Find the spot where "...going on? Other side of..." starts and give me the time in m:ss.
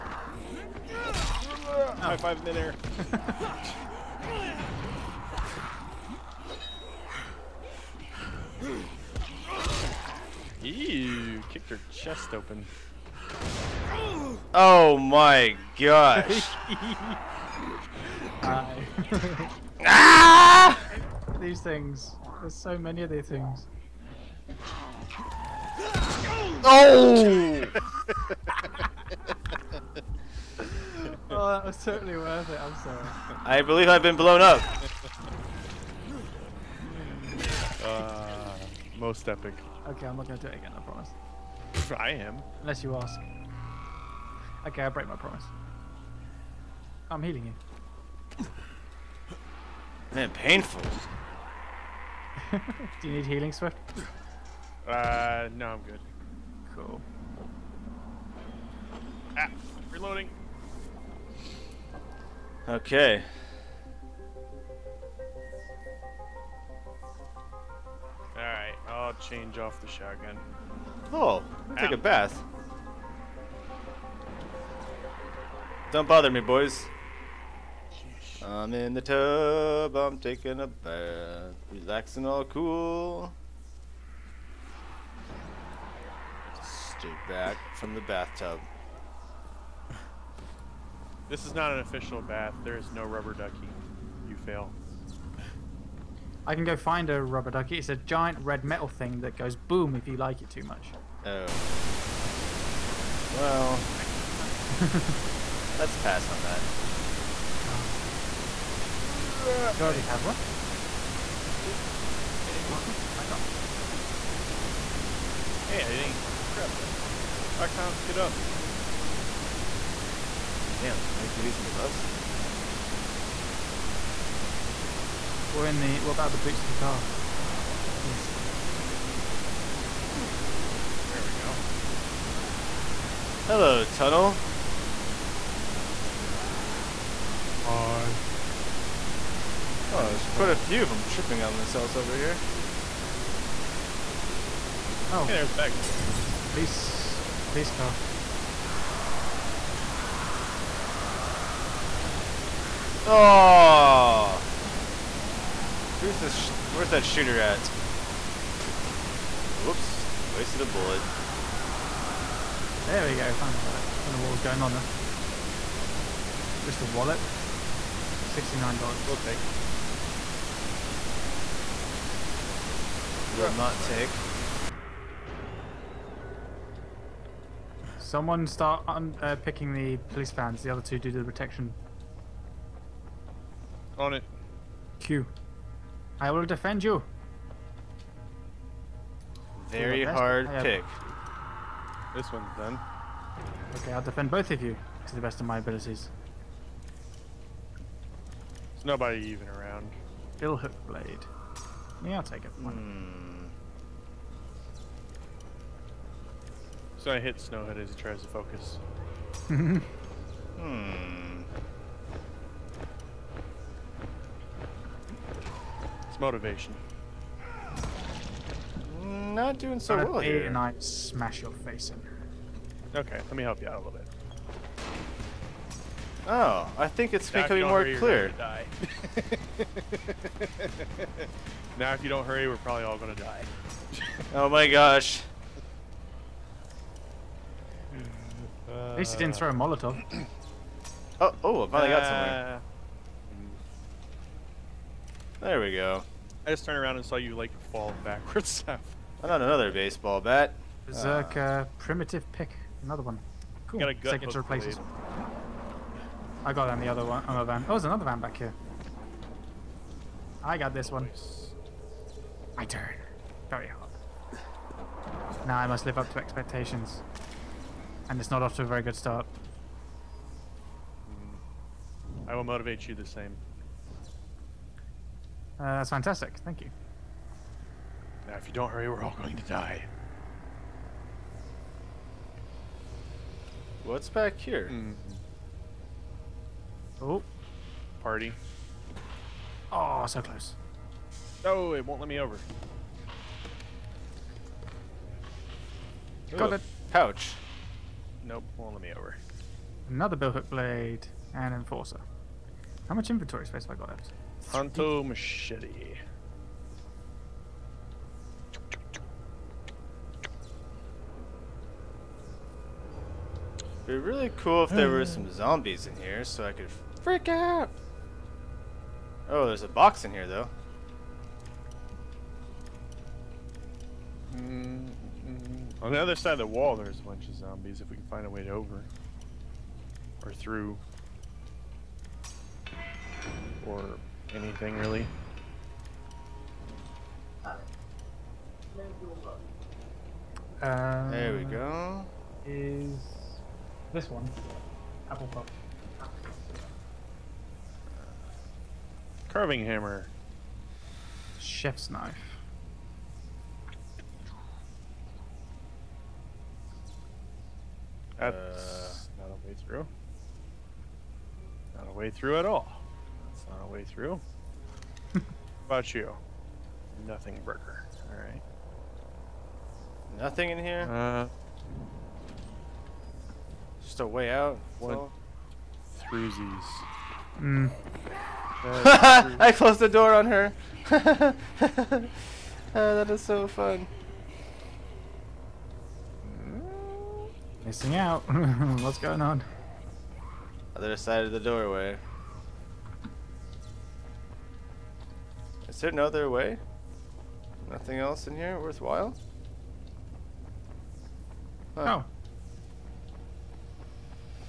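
6:28.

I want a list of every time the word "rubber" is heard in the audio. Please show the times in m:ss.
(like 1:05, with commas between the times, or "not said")
1:33, 1:37.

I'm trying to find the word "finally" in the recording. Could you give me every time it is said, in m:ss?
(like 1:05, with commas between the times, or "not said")
2:43, 4:01.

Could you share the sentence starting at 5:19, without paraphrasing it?
Oh, there's a box in here though.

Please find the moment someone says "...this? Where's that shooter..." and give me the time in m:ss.
2:36.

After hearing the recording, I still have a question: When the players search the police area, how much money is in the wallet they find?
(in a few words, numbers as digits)
$69.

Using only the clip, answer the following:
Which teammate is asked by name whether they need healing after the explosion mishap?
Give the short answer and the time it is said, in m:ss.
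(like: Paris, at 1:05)
Swift, at 0:53.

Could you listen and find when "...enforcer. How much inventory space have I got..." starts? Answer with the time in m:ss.
5:01.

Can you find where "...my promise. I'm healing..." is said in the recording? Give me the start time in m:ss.
0:45.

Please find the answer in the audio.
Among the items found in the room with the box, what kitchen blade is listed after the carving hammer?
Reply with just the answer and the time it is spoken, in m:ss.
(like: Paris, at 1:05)
Chef's knife, at 5:51.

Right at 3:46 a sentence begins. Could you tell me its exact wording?
Oh, I think it's now becoming more hurry, clear.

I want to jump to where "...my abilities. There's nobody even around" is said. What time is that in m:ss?
3:15.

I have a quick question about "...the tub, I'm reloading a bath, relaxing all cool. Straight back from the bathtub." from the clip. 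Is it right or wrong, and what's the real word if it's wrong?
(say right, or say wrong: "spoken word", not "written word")
wrong: "taking", not "reloading".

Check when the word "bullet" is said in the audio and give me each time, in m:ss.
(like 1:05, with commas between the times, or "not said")
2:40.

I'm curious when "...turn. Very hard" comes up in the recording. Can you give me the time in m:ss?
4:22.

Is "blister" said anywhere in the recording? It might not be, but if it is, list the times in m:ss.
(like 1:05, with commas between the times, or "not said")
not said.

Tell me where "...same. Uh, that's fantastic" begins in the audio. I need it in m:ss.
4:33.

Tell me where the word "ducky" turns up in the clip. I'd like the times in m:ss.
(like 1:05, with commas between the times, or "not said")
1:33, 1:37.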